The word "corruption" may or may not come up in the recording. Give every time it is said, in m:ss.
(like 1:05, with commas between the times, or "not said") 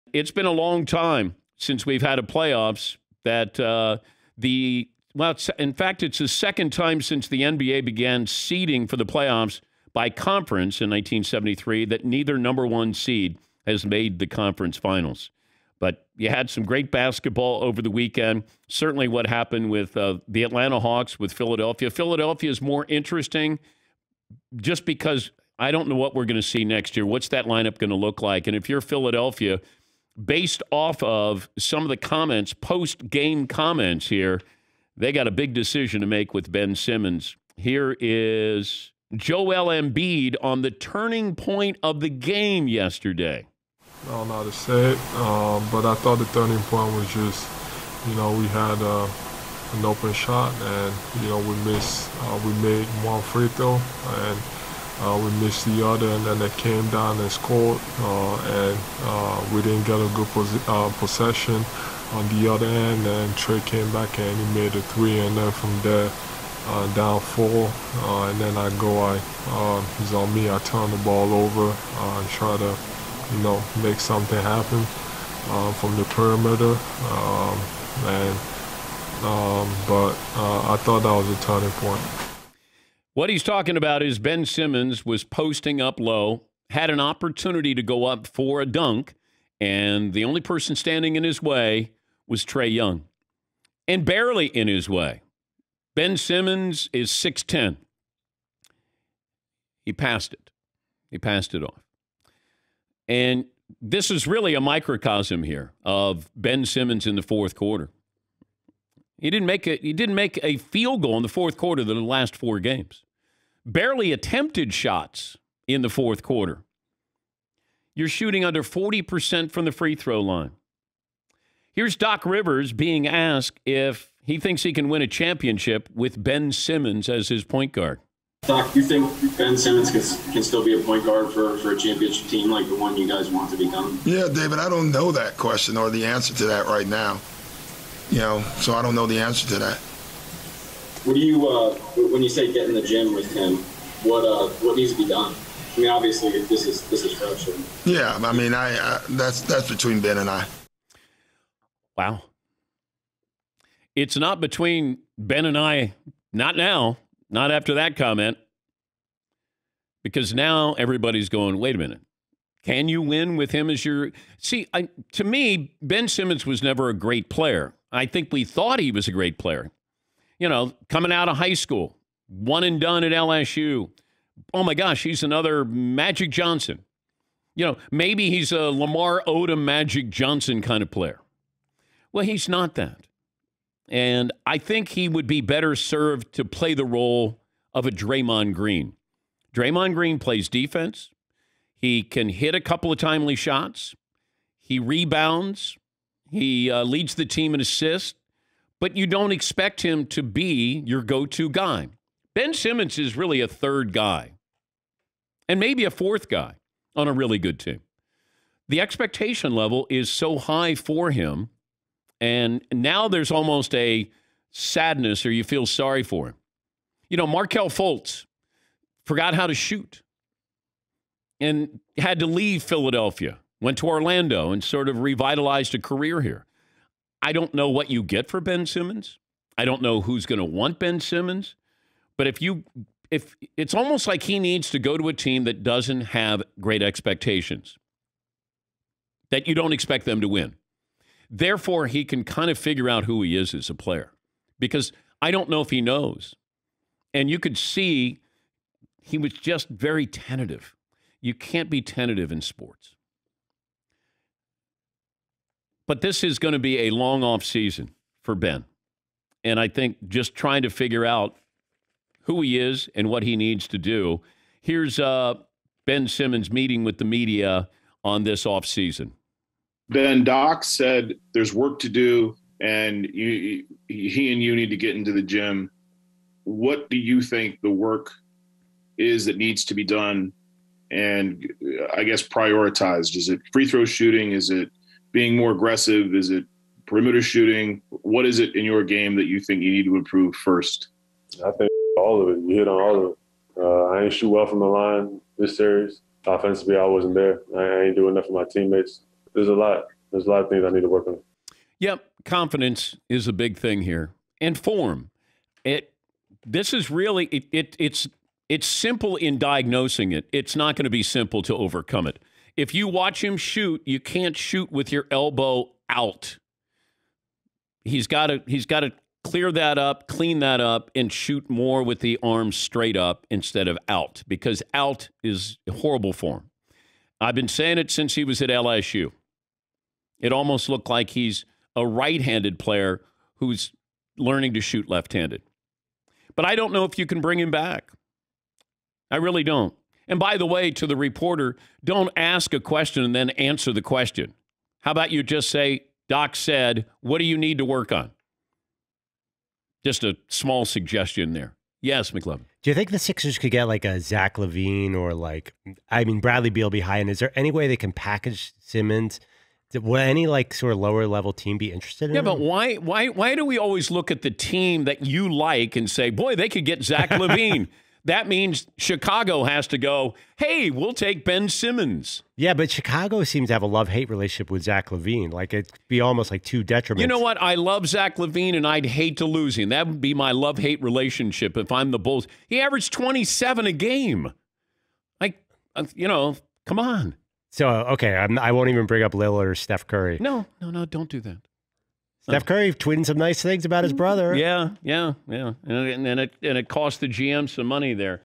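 2:27.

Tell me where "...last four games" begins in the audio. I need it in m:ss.
1:51.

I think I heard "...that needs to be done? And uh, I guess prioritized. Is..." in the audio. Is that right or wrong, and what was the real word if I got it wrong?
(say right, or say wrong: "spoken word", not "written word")
right.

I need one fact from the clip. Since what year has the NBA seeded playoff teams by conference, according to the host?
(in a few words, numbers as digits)
1973.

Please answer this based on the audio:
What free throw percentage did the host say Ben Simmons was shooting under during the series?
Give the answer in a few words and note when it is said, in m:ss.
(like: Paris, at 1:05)
40%, at 1:58.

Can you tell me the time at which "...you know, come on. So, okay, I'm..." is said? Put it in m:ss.
6:25.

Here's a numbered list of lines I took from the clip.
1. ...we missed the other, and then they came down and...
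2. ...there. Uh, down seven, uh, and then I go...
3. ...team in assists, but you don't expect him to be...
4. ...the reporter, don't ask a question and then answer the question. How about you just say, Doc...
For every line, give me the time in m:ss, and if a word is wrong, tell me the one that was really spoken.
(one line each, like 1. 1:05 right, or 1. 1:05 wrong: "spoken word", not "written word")
1. 0:55 right
2. 1:05 wrong: "four", not "seven"
3. 3:17 right
4. 5:40 right.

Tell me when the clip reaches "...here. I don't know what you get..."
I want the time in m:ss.
3:46.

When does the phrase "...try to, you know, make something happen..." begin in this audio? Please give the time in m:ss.
1:12.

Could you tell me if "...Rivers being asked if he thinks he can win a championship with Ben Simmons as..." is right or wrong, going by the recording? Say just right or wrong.
right.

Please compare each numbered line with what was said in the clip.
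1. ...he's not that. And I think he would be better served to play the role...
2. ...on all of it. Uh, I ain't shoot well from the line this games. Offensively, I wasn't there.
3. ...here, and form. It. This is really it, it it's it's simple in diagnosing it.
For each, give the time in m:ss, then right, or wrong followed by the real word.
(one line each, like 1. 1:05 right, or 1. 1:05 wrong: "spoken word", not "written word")
1. 3:02 right
2. 4:52 wrong: "series", not "games"
3. 5:03 right.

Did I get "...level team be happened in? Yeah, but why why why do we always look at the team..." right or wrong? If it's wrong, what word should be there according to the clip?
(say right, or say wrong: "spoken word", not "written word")
wrong: "interested", not "happened".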